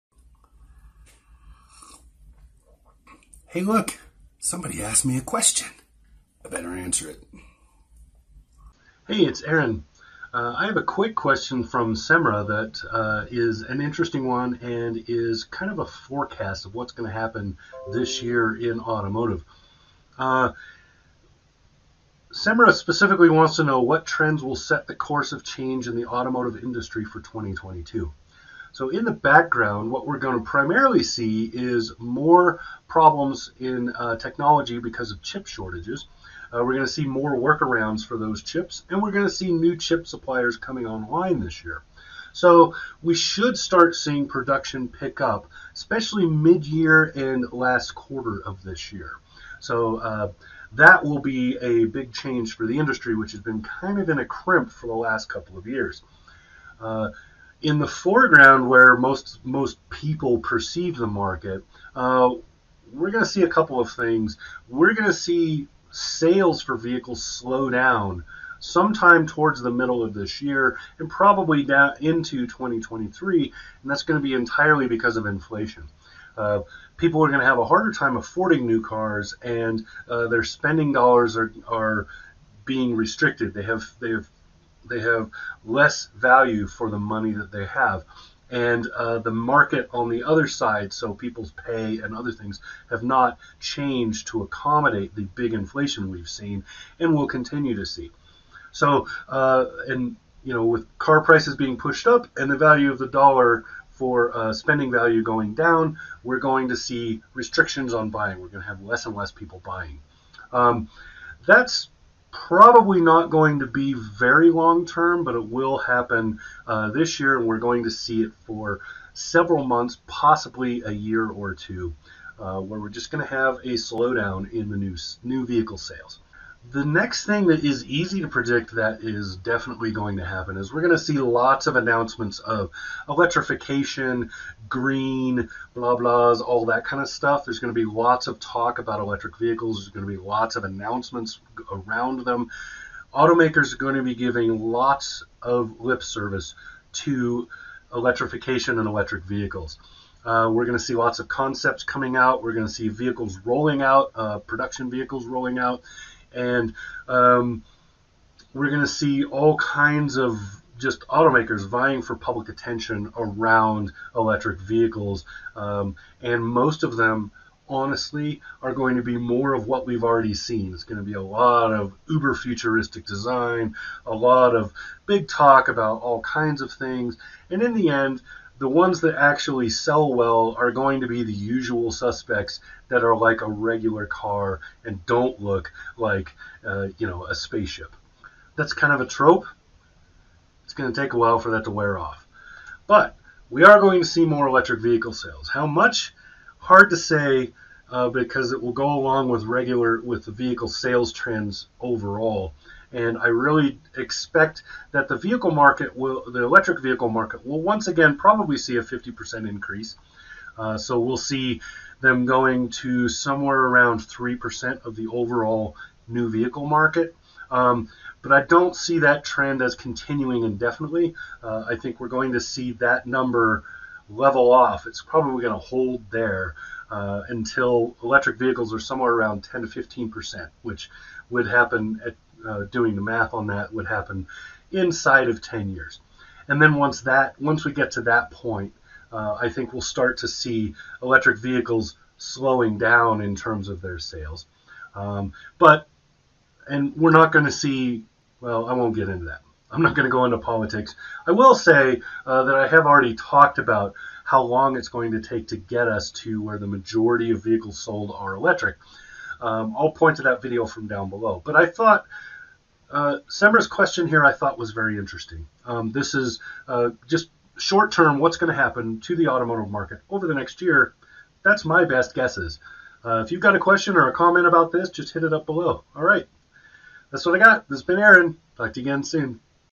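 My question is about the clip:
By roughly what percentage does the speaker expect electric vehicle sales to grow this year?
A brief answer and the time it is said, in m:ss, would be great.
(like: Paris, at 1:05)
50%, at 3:28.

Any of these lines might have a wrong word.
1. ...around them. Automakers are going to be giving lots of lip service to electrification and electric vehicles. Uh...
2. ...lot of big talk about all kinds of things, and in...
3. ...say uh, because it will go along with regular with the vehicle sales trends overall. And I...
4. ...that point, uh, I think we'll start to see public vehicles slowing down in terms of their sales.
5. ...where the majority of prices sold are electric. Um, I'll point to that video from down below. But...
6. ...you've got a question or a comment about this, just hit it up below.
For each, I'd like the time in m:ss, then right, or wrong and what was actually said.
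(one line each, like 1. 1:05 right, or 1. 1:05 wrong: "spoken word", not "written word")
1. 2:21 right
2. 2:54 right
3. 3:16 right
4. 3:58 wrong: "electric", not "public"
5. 4:16 wrong: "vehicles", not "prices"
6. 4:33 right.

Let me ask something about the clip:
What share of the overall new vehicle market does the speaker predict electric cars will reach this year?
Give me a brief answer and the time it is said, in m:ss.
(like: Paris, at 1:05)
3%, at 3:34.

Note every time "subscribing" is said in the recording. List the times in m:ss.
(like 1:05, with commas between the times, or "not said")
not said.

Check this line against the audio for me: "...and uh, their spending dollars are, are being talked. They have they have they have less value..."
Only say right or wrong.
wrong.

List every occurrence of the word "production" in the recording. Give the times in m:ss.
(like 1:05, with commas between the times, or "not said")
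0:44, 2:34.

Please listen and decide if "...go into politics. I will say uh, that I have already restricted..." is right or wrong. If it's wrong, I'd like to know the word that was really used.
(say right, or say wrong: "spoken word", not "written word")
wrong: "talked", not "restricted".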